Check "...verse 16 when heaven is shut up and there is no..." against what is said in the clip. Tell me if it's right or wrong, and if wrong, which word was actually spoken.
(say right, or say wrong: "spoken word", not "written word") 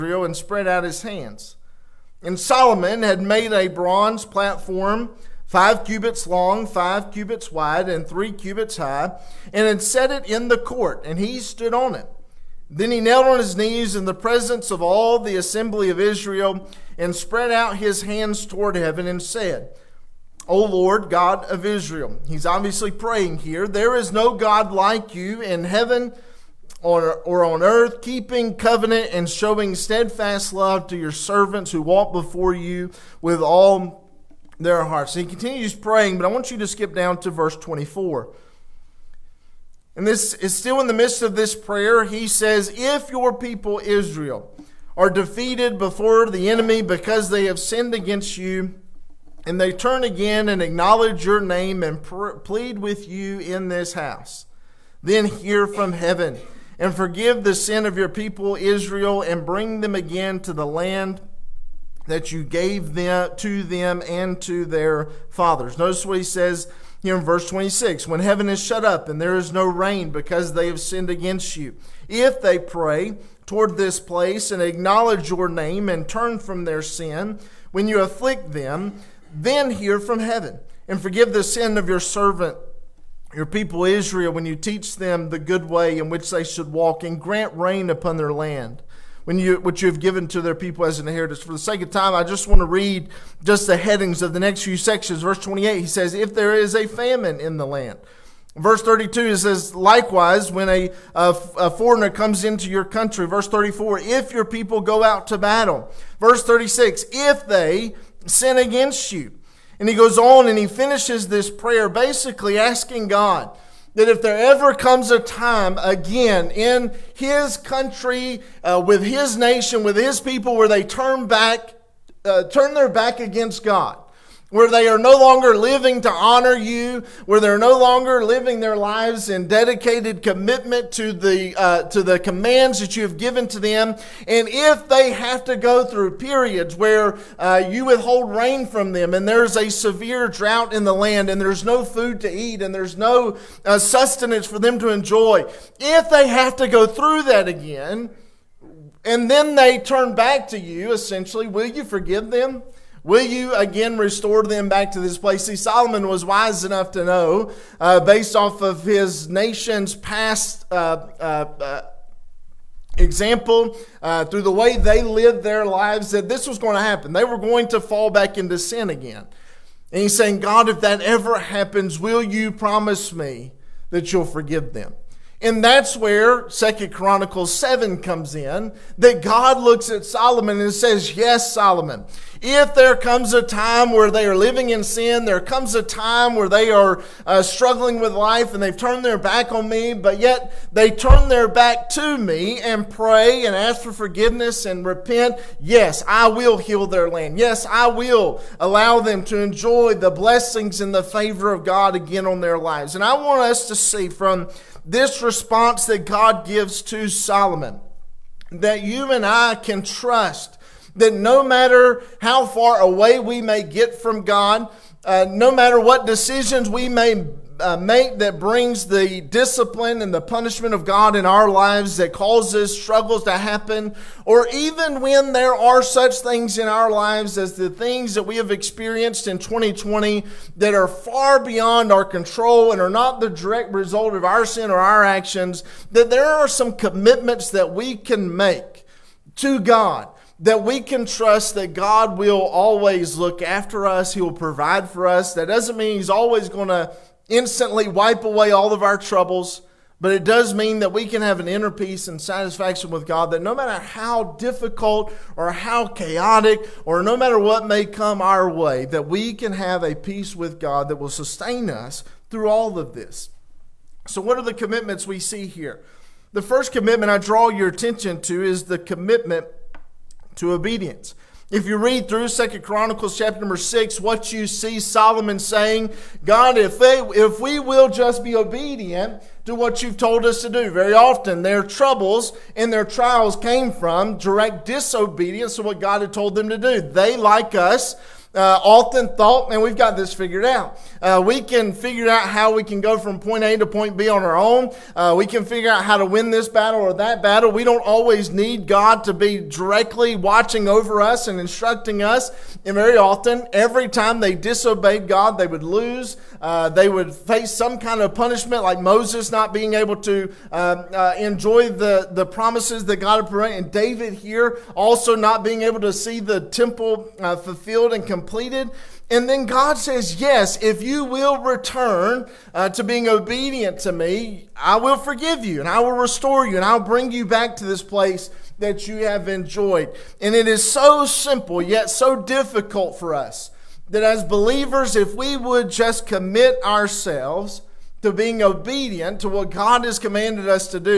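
wrong: "26", not "16".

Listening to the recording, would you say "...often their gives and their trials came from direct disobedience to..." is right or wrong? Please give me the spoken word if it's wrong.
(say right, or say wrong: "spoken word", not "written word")
wrong: "troubles", not "gives".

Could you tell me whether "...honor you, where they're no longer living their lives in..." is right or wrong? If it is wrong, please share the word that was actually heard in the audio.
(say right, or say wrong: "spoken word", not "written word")
right.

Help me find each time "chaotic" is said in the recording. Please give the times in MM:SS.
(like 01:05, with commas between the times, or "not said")
04:15.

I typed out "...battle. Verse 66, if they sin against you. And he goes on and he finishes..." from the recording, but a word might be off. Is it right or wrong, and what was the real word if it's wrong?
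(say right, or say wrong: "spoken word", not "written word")
wrong: "36", not "66".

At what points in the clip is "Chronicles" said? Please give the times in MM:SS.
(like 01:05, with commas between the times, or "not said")
02:56, 04:32.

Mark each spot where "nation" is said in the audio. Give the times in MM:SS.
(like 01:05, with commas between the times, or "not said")
01:59, 02:39.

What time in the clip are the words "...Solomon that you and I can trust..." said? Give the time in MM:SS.
03:27.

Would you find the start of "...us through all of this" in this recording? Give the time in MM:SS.
04:21.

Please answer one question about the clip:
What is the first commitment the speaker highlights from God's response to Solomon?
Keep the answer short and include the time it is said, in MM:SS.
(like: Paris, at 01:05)
Obedience, at 04:28.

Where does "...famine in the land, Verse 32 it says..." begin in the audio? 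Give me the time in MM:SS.
01:36.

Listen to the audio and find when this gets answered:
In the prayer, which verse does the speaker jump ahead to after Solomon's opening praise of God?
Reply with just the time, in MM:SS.
00:37.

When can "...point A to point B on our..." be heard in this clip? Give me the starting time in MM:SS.
04:53.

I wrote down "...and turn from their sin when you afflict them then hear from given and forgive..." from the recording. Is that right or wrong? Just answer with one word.
wrong.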